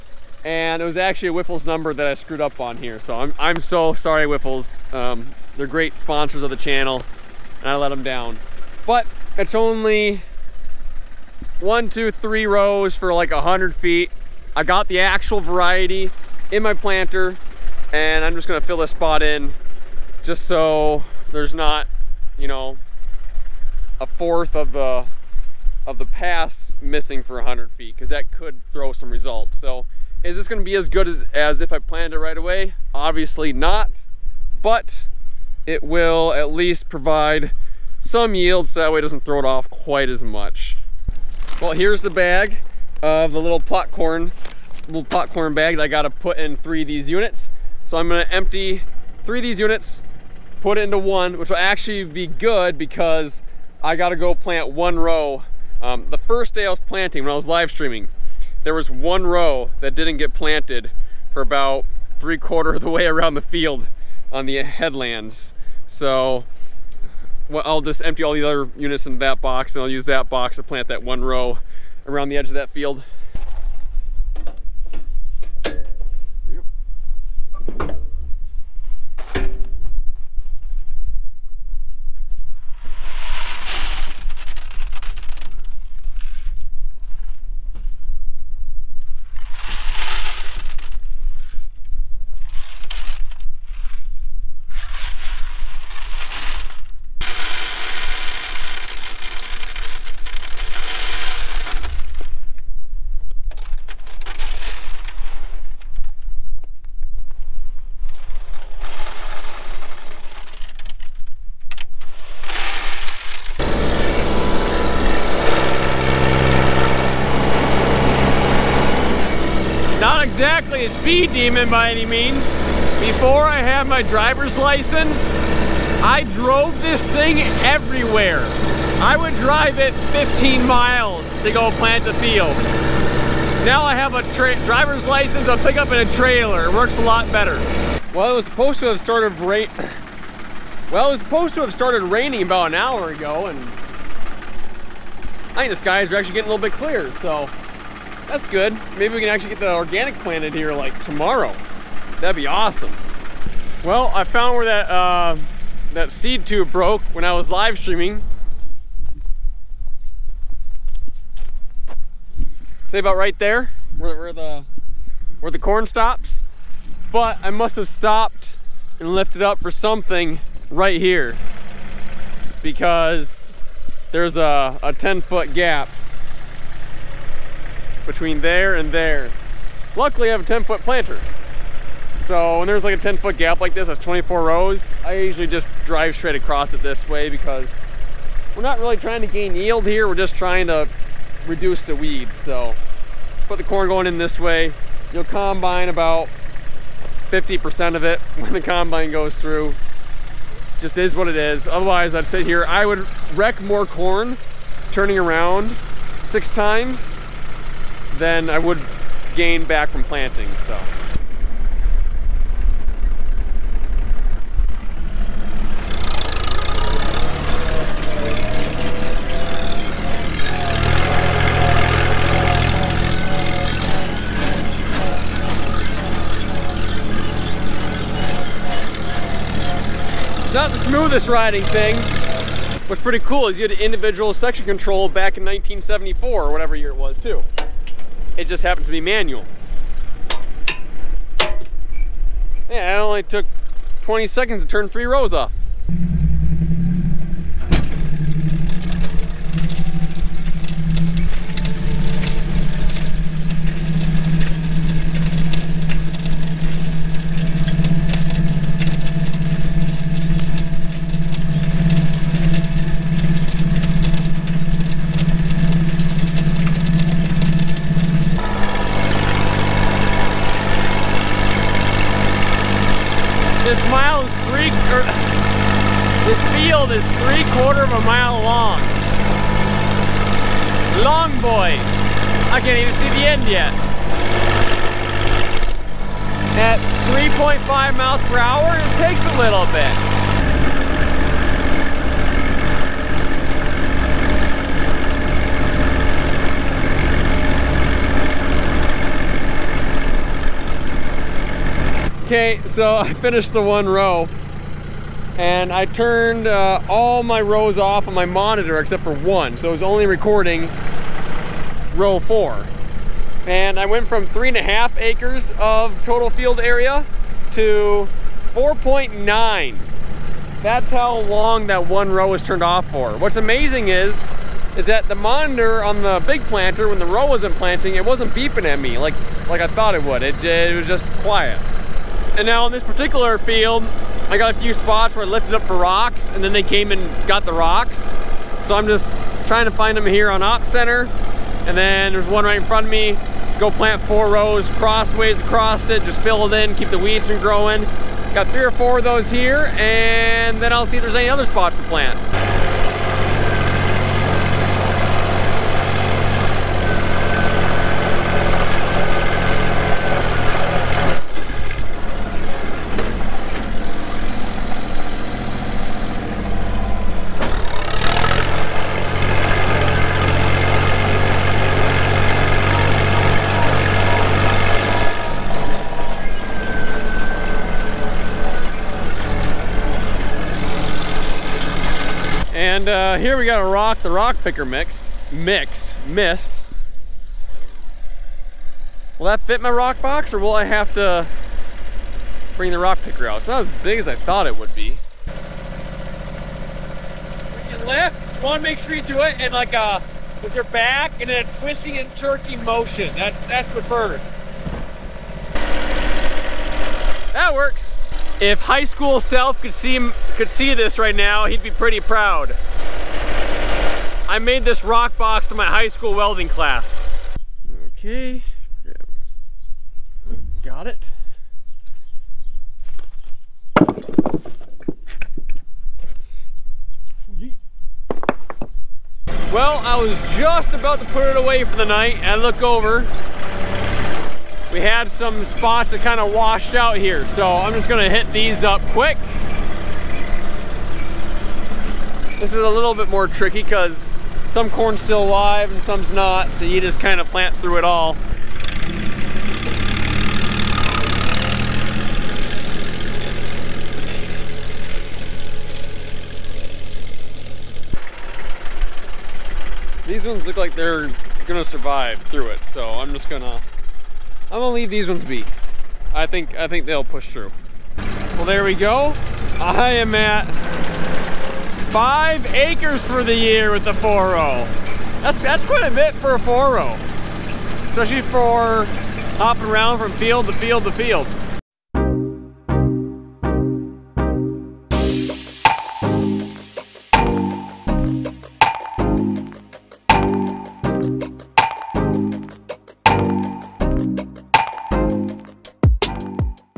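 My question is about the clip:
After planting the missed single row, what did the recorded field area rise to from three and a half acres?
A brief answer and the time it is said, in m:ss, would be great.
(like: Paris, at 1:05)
4.9, at 5:18.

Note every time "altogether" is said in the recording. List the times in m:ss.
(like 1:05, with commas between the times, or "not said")
not said.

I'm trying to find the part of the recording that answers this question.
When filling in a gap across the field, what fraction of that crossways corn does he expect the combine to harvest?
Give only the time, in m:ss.
3:17.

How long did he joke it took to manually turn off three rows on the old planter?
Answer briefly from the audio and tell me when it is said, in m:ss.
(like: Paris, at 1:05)
20 seconds, at 4:04.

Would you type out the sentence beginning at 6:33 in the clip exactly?
It's not as big as I thought it would be.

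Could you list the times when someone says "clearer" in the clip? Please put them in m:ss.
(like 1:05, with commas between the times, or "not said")
2:26.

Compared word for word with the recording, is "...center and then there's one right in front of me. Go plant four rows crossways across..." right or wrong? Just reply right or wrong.
right.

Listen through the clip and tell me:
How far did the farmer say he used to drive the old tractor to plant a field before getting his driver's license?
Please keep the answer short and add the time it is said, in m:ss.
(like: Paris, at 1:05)
15 miles, at 2:10.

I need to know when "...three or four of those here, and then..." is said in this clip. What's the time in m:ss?
5:48.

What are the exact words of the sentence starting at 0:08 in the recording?
But it's only one, two, three rows for like 100 feet.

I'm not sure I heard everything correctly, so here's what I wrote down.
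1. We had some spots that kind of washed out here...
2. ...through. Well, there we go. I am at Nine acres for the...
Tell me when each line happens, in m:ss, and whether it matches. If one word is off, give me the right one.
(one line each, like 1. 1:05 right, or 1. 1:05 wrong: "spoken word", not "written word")
1. 7:14 right
2. 7:47 wrong: "Five", not "Nine".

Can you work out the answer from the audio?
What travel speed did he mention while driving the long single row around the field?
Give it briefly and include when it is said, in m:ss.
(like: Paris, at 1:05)
3.5 miles per hour, at 4:47.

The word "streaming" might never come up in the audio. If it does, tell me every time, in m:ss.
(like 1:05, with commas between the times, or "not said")
0:57, 2:37.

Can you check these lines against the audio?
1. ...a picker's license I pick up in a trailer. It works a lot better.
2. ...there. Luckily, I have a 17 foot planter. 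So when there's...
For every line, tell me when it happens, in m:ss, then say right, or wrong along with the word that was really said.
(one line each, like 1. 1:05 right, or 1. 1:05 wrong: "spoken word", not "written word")
1. 2:14 wrong: "driver", not "picker"
2. 2:58 wrong: "10", not "17".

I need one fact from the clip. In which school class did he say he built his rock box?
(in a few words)
welding class.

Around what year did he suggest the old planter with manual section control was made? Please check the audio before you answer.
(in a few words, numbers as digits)
1974.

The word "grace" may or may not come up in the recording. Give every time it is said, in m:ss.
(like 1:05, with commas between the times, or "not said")
not said.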